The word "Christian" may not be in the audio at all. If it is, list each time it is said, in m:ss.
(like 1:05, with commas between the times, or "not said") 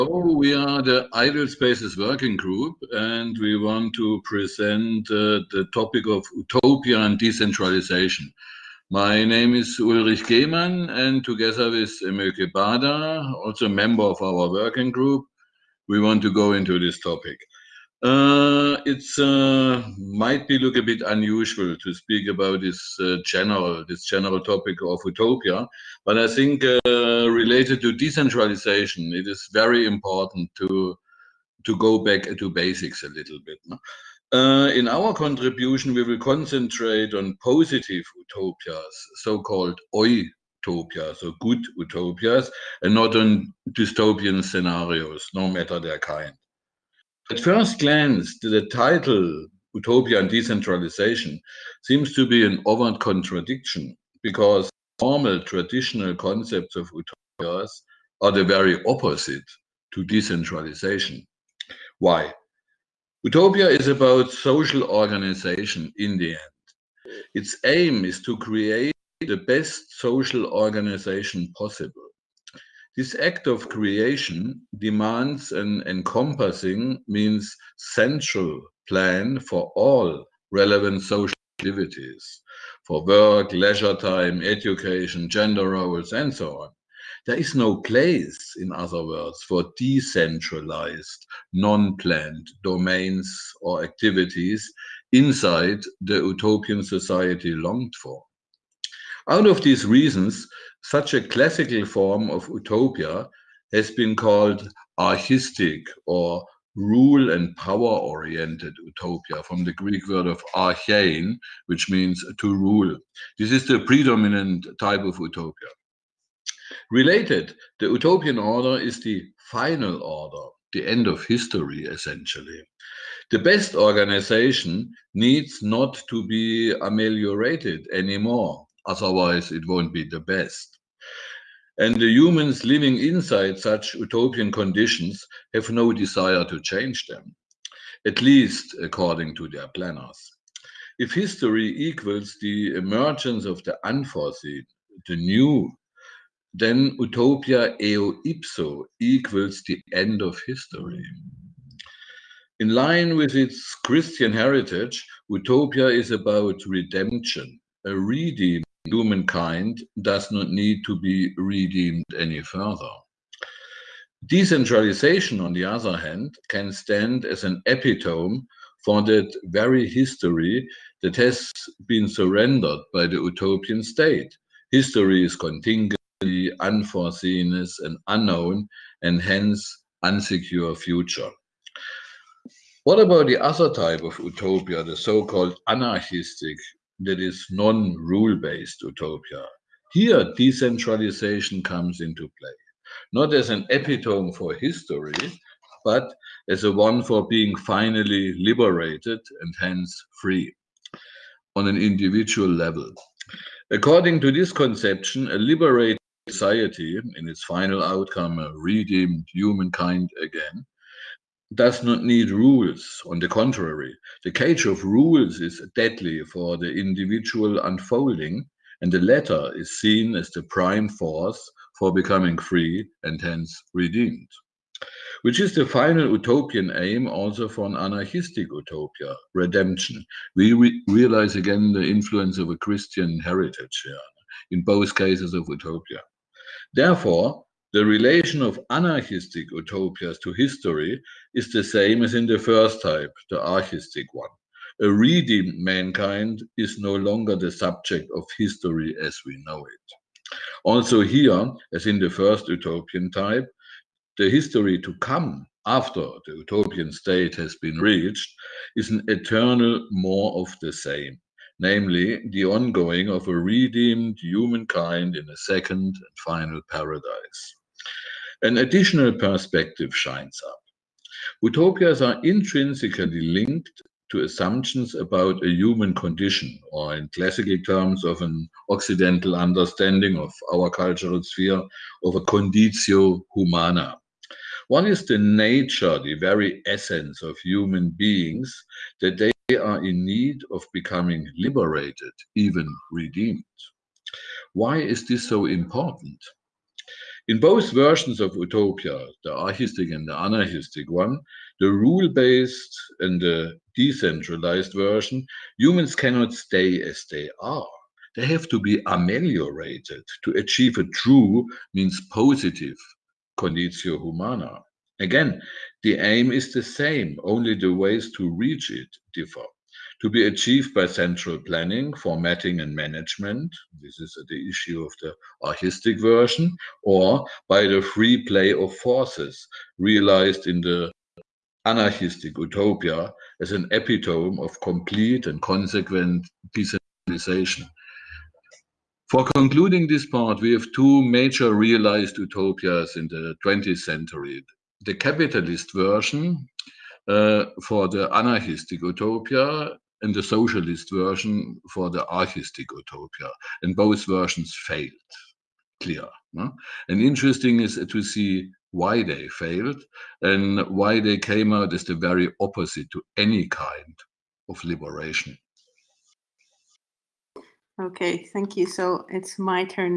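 2:33, 3:52.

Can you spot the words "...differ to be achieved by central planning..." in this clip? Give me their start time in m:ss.
5:19.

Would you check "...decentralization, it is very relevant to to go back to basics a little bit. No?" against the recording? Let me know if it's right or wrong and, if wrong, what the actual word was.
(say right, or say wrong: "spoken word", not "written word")
wrong: "important", not "relevant".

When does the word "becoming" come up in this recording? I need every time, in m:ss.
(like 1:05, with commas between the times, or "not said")
3:41, 4:50.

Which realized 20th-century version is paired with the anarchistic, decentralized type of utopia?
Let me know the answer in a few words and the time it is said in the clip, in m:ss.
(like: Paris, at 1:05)
capitalist, at 5:44.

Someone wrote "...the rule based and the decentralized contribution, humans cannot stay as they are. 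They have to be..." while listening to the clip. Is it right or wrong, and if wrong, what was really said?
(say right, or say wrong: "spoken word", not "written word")
wrong: "version", not "contribution".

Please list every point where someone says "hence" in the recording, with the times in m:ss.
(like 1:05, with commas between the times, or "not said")
2:59, 3:19, 3:43.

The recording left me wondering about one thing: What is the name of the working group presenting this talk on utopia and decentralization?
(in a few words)
Ideal Spaces Working Group.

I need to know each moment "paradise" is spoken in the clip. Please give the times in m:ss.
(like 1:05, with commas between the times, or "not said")
4:26.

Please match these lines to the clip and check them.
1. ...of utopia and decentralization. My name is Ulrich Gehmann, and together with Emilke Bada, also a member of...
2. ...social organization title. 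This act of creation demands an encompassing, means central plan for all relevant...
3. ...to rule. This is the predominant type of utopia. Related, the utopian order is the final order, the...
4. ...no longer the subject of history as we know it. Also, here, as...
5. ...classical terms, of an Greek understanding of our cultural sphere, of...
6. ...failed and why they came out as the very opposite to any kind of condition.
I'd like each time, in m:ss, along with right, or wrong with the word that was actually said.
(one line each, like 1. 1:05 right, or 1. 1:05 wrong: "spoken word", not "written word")
1. 0:06 right
2. 1:09 wrong: "possible", not "title"
3. 1:52 right
4. 4:06 right
5. 4:37 wrong: "Occidental", not "Greek"
6. 5:59 wrong: "liberation", not "condition".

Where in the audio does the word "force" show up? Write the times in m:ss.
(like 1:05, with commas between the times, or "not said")
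3:40, 5:28.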